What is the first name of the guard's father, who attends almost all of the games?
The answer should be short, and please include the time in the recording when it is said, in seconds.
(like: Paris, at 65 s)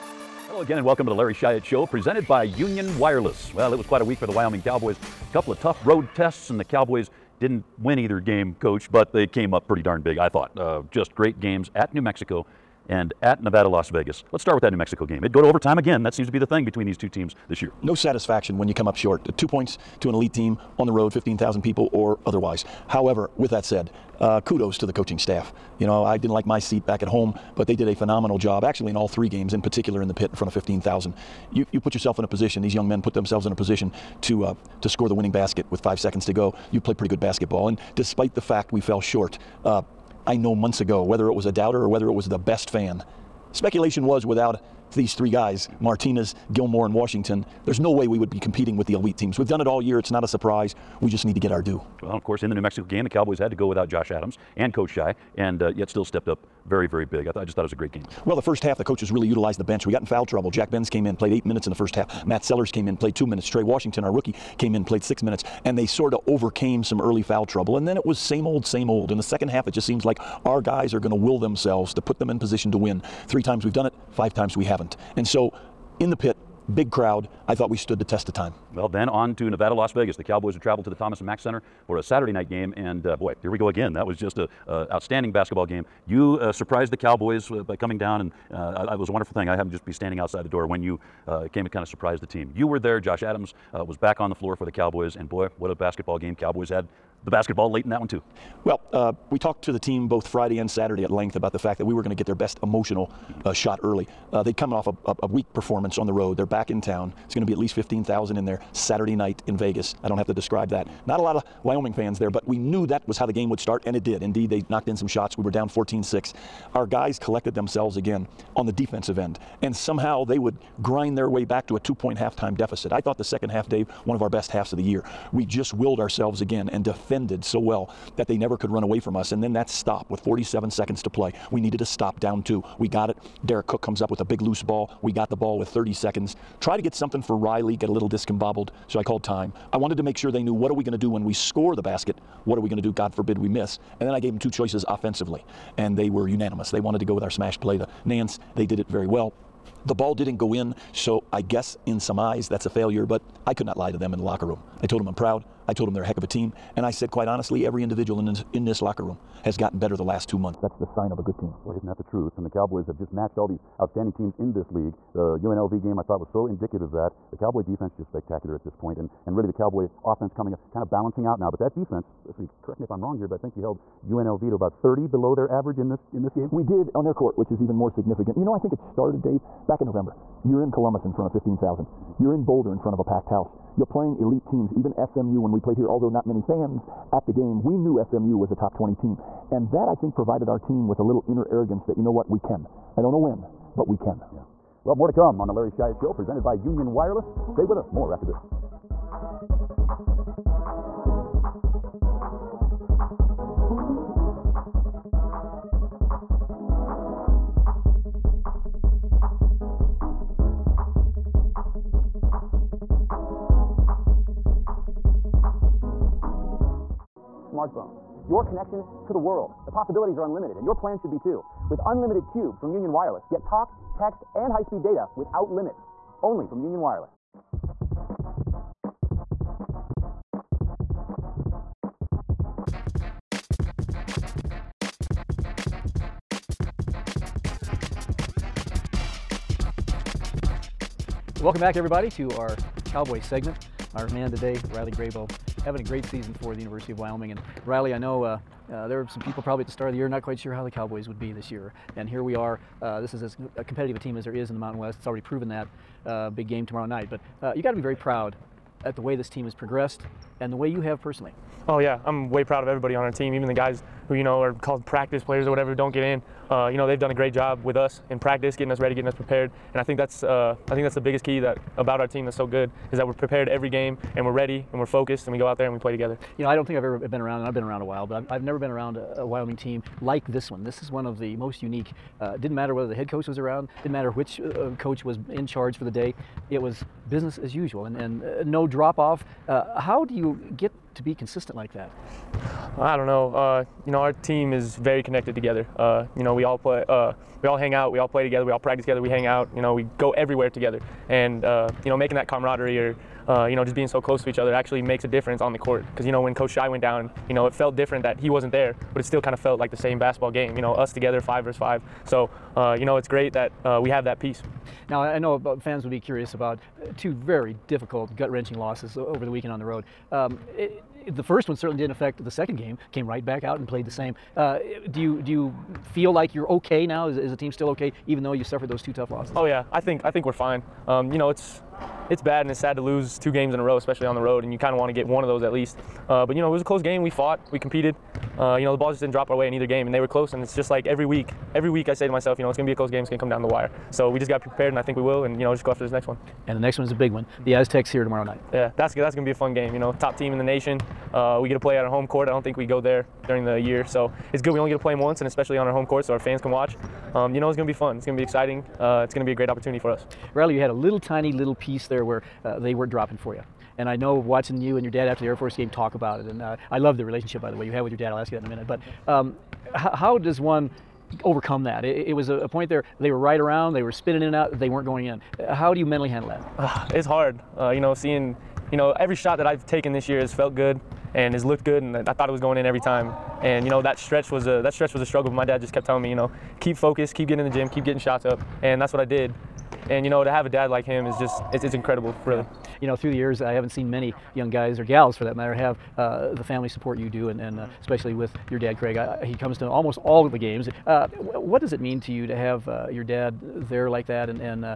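Craig, at 398 s.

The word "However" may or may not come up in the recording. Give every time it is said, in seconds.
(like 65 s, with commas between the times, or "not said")
22 s.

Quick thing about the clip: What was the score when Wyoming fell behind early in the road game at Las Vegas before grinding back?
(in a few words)
14-6.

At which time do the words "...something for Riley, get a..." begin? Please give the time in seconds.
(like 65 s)
136 s.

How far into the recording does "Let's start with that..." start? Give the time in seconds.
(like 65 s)
14 s.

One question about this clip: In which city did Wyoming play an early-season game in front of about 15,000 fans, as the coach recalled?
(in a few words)
Columbus.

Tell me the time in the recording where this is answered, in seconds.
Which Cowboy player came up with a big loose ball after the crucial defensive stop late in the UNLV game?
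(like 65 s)
133 s.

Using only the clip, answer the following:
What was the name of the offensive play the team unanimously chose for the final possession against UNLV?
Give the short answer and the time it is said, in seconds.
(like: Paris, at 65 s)
The Nance, at 147 s.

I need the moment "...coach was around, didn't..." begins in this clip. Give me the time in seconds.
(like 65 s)
283 s.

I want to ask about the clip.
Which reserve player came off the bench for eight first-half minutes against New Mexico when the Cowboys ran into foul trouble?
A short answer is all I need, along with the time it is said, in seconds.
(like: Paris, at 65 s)
Jack Benz, at 60 s.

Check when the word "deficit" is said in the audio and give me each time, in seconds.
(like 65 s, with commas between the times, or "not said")
122 s.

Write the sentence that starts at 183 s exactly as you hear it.
You're playing elite teams, even SMU when we played here, although not many fans at the game.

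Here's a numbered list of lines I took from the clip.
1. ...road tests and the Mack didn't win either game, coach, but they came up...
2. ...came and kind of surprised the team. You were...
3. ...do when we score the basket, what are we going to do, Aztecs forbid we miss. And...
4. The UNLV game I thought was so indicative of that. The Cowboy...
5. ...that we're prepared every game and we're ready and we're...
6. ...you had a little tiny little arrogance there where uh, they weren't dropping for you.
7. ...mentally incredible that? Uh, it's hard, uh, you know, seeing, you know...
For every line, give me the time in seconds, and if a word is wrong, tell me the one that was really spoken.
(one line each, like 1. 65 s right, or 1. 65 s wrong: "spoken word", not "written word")
1. 5 s wrong: "Cowboys", not "Mack"
2. 91 s right
3. 140 s wrong: "God", not "Aztecs"
4. 165 s right
5. 272 s right
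6. 360 s wrong: "piece", not "arrogance"
7. 375 s wrong: "handle", not "incredible".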